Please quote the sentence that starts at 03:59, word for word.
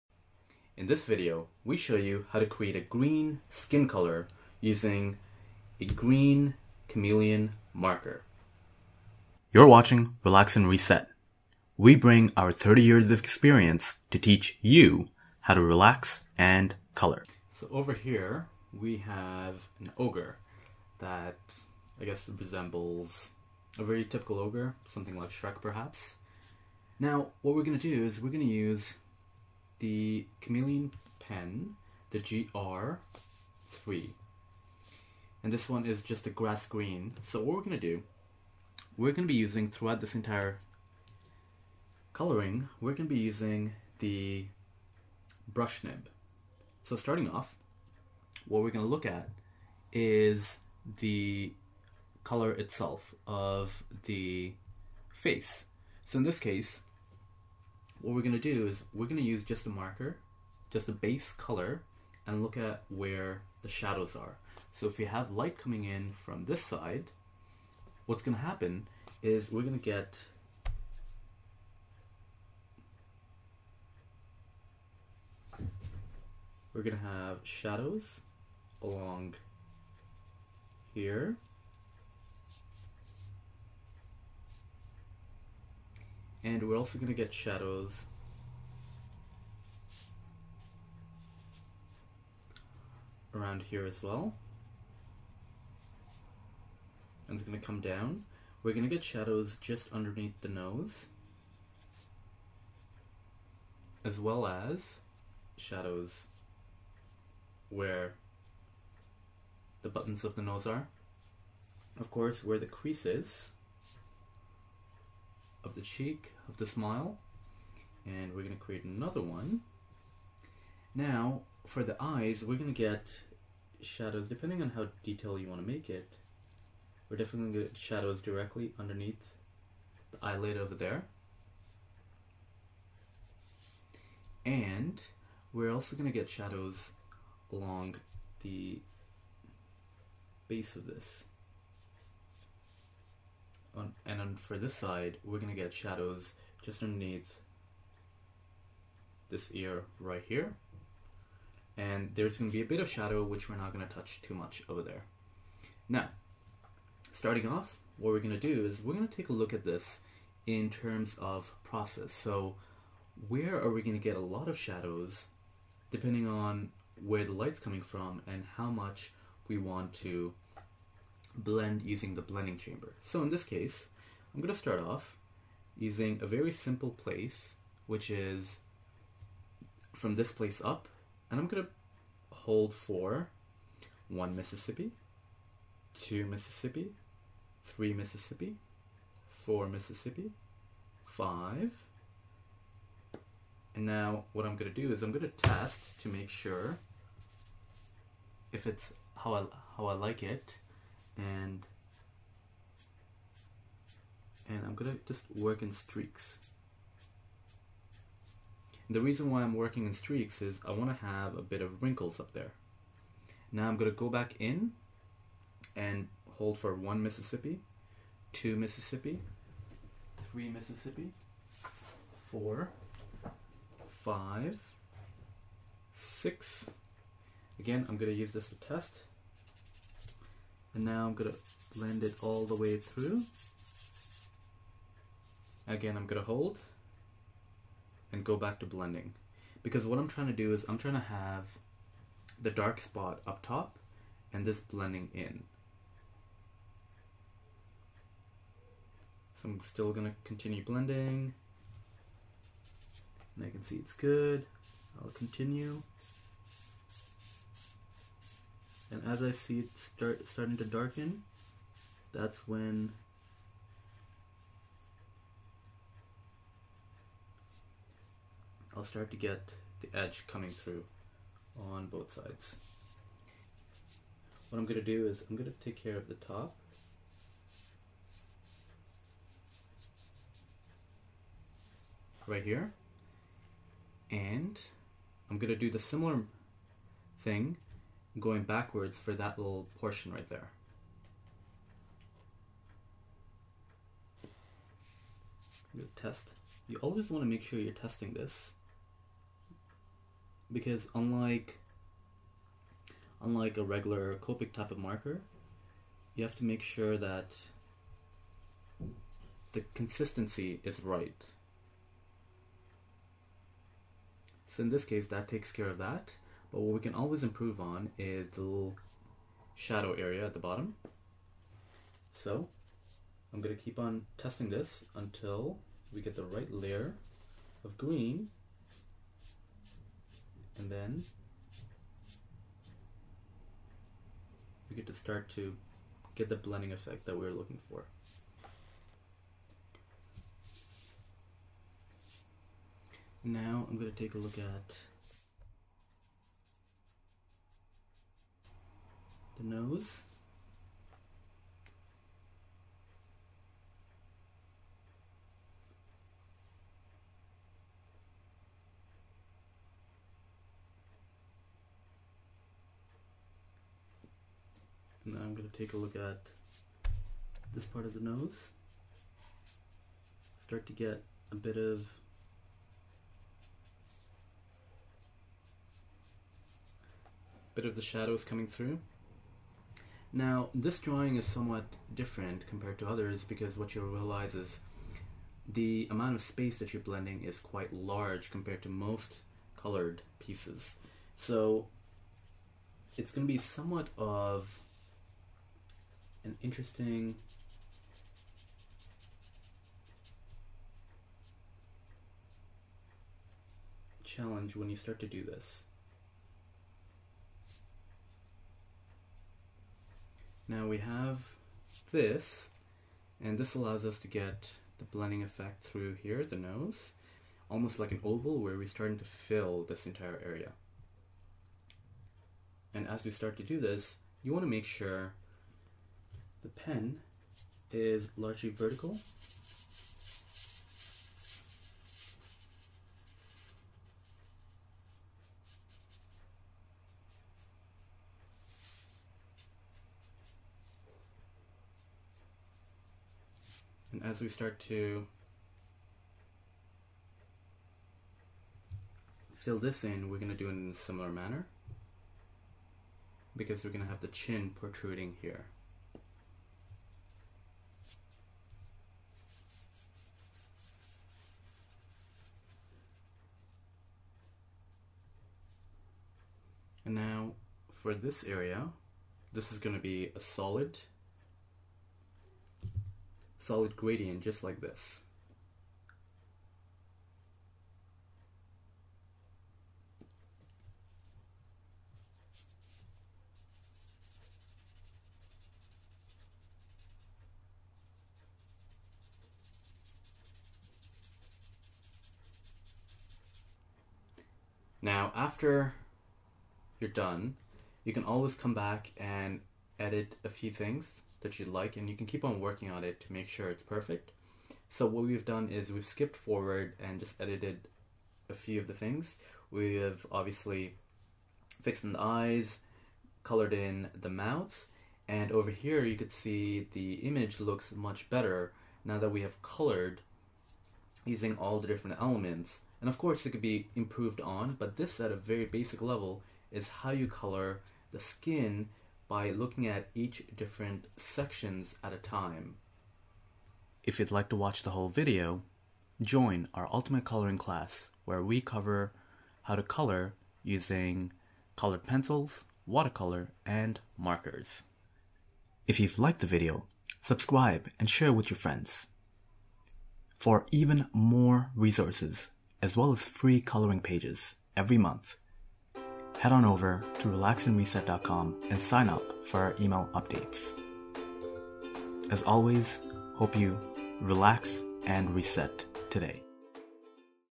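Because what I'm trying to do is I'm trying to have the dark spot up top and this blending in.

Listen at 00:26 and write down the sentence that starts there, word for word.
Now, what we're going to do is we're going to use the Chameleon pen, the GR3.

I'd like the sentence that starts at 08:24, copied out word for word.
So what we've done is we've skipped forward and just edited a few of the things.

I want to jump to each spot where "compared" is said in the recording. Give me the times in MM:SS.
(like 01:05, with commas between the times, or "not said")
06:22, 06:28.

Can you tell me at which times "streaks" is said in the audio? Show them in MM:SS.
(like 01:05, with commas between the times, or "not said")
03:25, 03:29.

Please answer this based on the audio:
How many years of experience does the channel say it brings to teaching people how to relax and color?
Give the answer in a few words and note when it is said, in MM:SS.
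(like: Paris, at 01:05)
30, at 00:12.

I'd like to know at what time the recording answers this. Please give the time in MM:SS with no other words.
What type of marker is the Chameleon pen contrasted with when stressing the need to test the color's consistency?
05:04.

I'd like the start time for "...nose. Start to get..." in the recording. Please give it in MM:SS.
06:07.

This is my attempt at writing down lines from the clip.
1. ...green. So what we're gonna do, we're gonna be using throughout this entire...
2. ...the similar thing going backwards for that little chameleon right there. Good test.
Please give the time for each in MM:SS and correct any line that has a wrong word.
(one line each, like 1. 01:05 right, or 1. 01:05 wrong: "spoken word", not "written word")
1. 00:36 right
2. 04:45 wrong: "portion", not "chameleon".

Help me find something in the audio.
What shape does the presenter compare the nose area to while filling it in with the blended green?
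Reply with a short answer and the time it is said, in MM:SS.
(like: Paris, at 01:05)
Oval, at 06:58.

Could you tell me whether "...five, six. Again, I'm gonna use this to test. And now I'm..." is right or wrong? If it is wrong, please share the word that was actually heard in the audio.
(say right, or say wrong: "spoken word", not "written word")
right.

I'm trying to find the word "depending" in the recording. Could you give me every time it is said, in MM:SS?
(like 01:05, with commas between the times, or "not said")
02:04, 02:45.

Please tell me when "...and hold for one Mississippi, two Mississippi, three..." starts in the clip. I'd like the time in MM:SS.
03:35.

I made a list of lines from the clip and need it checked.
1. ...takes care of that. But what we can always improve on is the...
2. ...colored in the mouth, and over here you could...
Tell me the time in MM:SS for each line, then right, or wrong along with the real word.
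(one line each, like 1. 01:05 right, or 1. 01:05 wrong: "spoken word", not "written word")
1. 05:15 right
2. 08:33 right.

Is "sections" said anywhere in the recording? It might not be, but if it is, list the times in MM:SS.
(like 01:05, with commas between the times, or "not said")
08:50.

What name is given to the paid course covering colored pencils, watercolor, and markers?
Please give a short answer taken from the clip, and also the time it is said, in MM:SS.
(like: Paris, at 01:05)
Ultimate Coloring class, at 08:56.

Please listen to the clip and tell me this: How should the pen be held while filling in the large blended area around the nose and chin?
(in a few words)
Largely vertical.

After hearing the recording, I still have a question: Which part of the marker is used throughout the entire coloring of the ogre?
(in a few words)
Brush nib.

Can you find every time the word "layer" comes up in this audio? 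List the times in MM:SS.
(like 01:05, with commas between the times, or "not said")
05:26.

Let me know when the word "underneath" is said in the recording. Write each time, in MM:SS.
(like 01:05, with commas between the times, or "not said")
01:39, 02:08, 02:26.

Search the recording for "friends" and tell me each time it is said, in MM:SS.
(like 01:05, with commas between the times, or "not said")
09:08.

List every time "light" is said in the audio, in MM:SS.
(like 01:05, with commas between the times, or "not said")
01:05, 02:47.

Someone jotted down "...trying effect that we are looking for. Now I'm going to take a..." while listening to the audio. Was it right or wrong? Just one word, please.
wrong.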